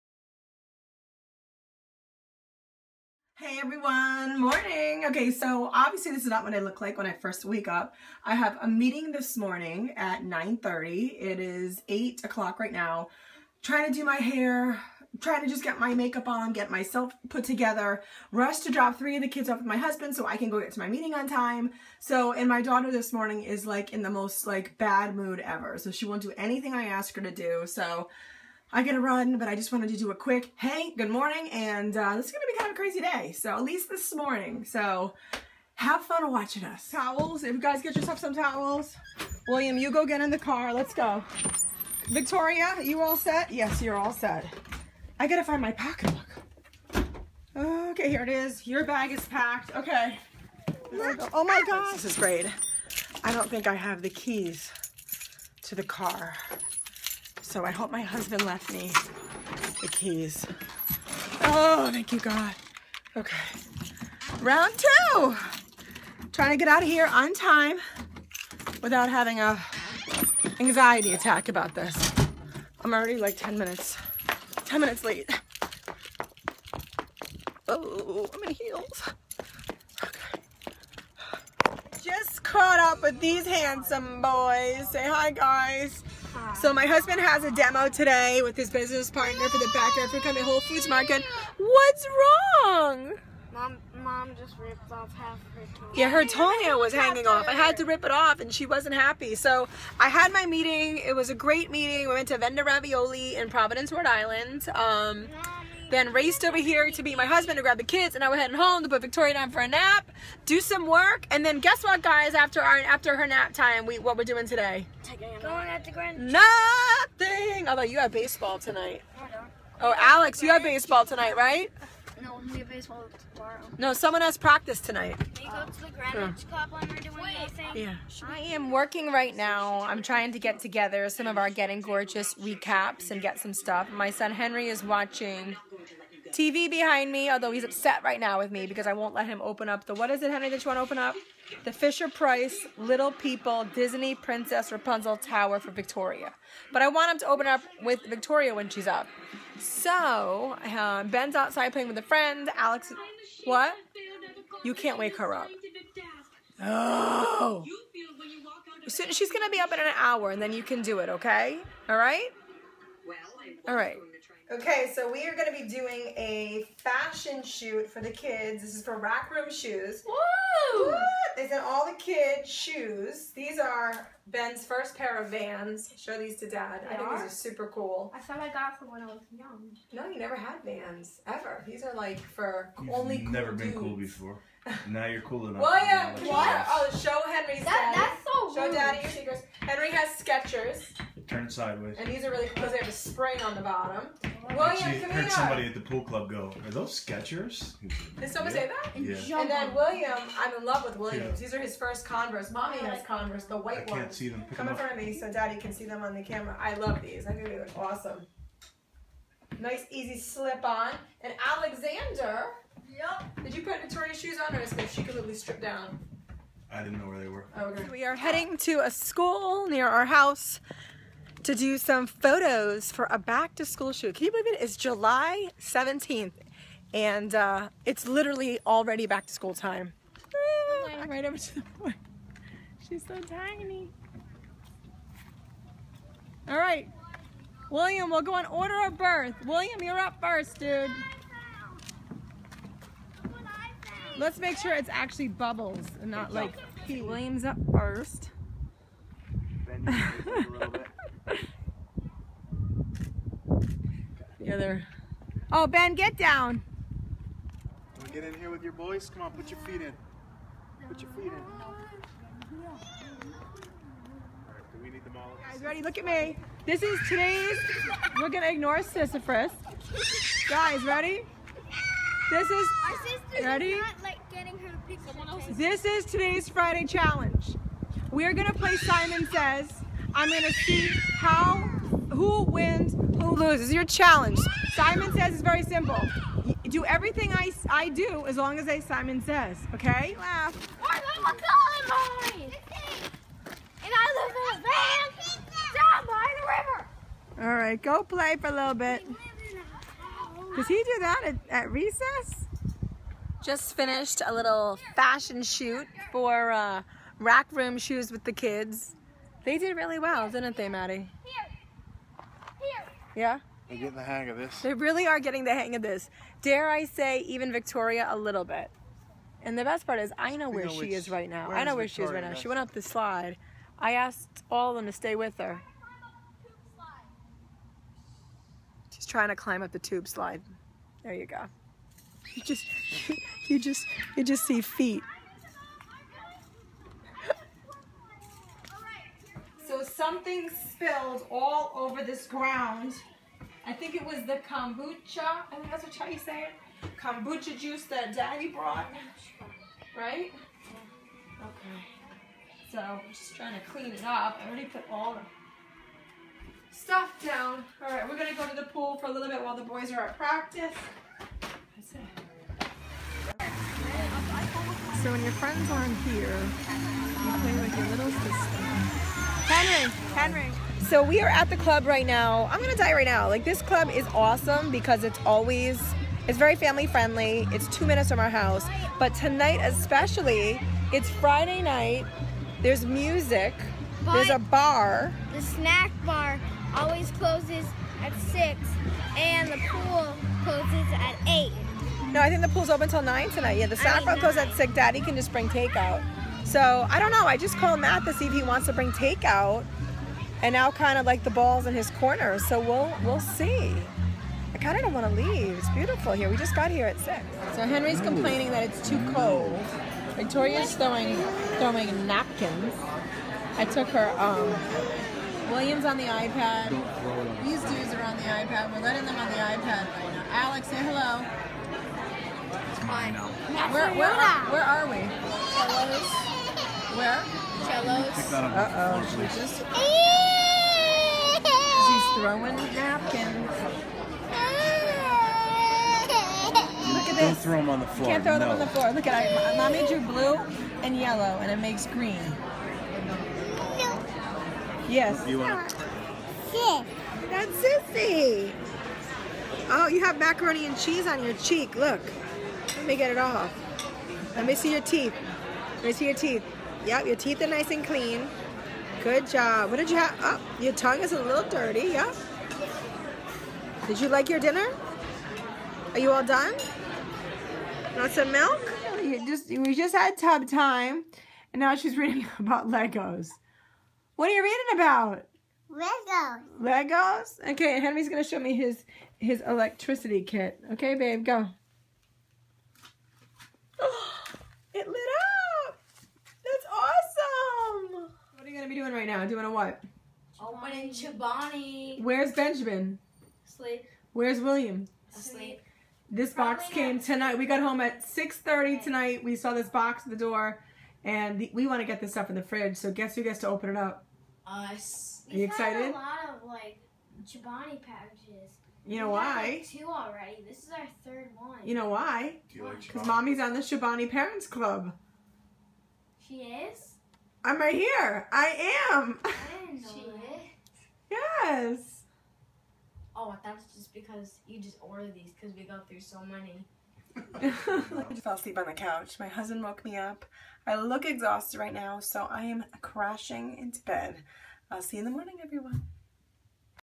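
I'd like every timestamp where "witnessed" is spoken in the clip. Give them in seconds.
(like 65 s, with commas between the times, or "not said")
not said.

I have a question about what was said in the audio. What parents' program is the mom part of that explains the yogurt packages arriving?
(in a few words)
Chobani Parents Club.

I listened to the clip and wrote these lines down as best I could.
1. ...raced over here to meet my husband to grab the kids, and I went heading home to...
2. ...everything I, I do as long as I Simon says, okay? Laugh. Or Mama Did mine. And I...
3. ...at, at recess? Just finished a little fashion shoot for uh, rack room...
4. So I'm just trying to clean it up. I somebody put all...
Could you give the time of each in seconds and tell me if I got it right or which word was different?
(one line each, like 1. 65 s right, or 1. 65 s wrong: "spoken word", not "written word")
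1. 106 s right
2. 286 s wrong: "Colin", not "Did"
3. 301 s right
4. 352 s wrong: "already", not "somebody".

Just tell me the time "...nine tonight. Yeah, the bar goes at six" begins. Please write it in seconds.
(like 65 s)
393 s.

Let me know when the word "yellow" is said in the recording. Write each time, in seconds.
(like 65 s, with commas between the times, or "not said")
440 s.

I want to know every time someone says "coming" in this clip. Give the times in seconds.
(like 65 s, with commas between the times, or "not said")
90 s.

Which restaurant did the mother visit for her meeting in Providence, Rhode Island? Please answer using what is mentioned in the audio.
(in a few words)
Venda Ravioli.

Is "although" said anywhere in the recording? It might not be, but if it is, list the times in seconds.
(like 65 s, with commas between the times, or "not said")
117 s, 137 s.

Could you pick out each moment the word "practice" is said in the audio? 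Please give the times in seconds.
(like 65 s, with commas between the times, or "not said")
124 s, 360 s.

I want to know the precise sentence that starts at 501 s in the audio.
And the, we want to get this stuff in the fridge.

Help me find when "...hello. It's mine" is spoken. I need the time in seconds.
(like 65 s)
420 s.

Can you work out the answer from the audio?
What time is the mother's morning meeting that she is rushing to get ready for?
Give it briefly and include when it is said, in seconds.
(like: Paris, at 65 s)
9:30, at 10 s.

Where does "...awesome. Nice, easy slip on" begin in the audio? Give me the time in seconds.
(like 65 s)
207 s.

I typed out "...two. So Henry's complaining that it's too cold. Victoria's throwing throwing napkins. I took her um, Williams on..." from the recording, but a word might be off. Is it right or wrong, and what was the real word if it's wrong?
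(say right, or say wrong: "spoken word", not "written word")
wrong: "six", not "two".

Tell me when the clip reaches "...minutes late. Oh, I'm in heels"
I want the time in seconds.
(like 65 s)
74 s.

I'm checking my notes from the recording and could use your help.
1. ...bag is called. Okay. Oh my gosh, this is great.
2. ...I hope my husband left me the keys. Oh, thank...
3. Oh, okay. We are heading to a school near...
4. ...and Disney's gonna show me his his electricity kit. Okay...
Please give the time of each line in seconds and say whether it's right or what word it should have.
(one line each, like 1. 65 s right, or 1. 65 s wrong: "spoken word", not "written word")
1. 48 s wrong: "packed", not "called"
2. 57 s right
3. 217 s right
4. 477 s wrong: "Henry", not "Disney".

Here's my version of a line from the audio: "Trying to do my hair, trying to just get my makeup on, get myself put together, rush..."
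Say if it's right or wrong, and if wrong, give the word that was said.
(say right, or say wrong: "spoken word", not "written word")
right.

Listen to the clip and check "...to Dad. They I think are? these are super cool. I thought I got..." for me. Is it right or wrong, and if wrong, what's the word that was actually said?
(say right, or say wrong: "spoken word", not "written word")
right.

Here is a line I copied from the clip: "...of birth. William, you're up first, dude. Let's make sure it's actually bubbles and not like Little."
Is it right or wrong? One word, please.
wrong.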